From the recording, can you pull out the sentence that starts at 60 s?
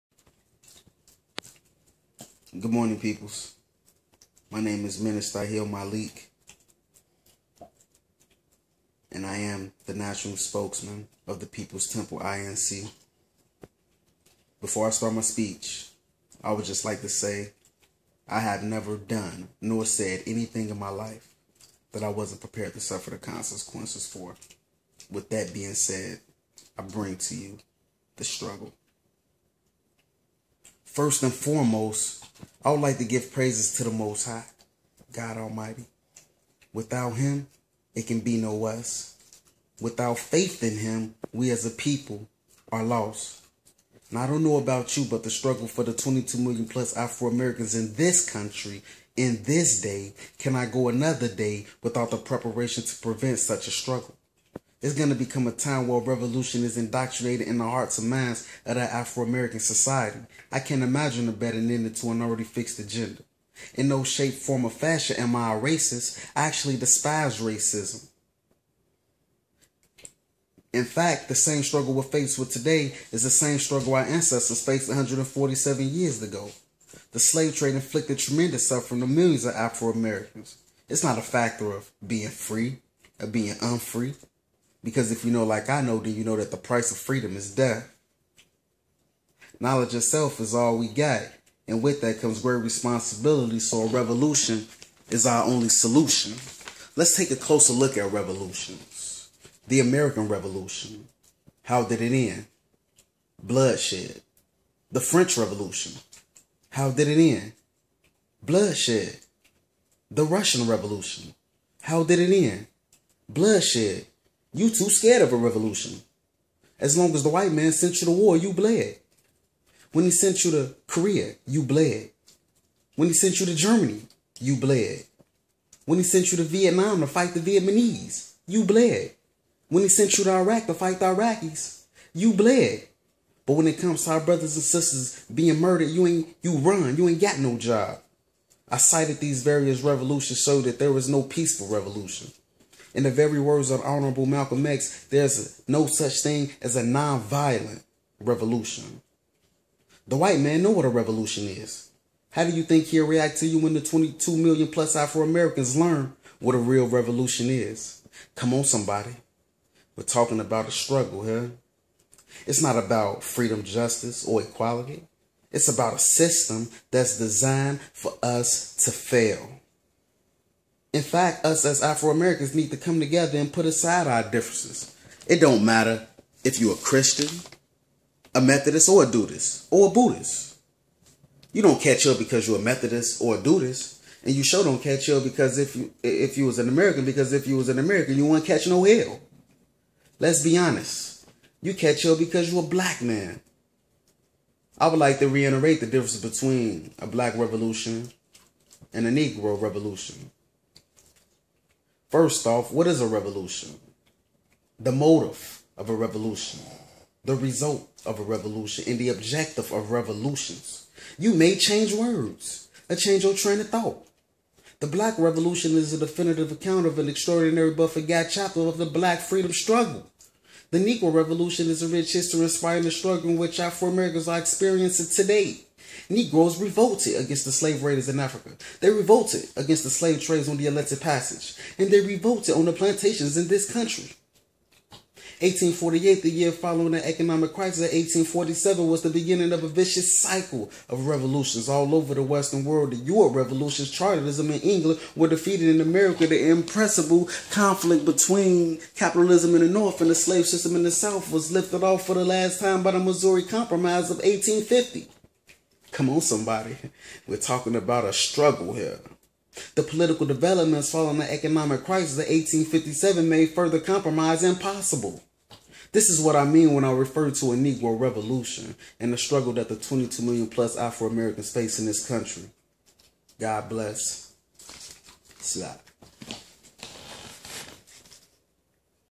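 I can't imagine a better ending to an already fixed agenda.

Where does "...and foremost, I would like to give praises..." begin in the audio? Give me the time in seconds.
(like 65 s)
31 s.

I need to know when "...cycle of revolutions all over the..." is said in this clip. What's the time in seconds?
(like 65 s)
240 s.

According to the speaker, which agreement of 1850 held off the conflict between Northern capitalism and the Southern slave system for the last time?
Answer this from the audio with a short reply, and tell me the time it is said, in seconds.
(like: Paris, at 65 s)
Missouri Compromise, at 252 s.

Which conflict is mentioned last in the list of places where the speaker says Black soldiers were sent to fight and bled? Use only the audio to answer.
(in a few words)
Iraq.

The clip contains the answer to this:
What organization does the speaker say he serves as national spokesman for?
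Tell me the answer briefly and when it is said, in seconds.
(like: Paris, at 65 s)
People's Temple INC, at 11 s.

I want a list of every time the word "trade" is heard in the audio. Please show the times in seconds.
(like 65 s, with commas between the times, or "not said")
77 s, 230 s.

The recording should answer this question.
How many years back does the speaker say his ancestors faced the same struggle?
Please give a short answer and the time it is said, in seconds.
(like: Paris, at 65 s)
147, at 74 s.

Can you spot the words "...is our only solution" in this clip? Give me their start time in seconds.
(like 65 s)
95 s.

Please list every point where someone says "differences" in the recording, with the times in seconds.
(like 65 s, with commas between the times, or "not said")
174 s, 195 s.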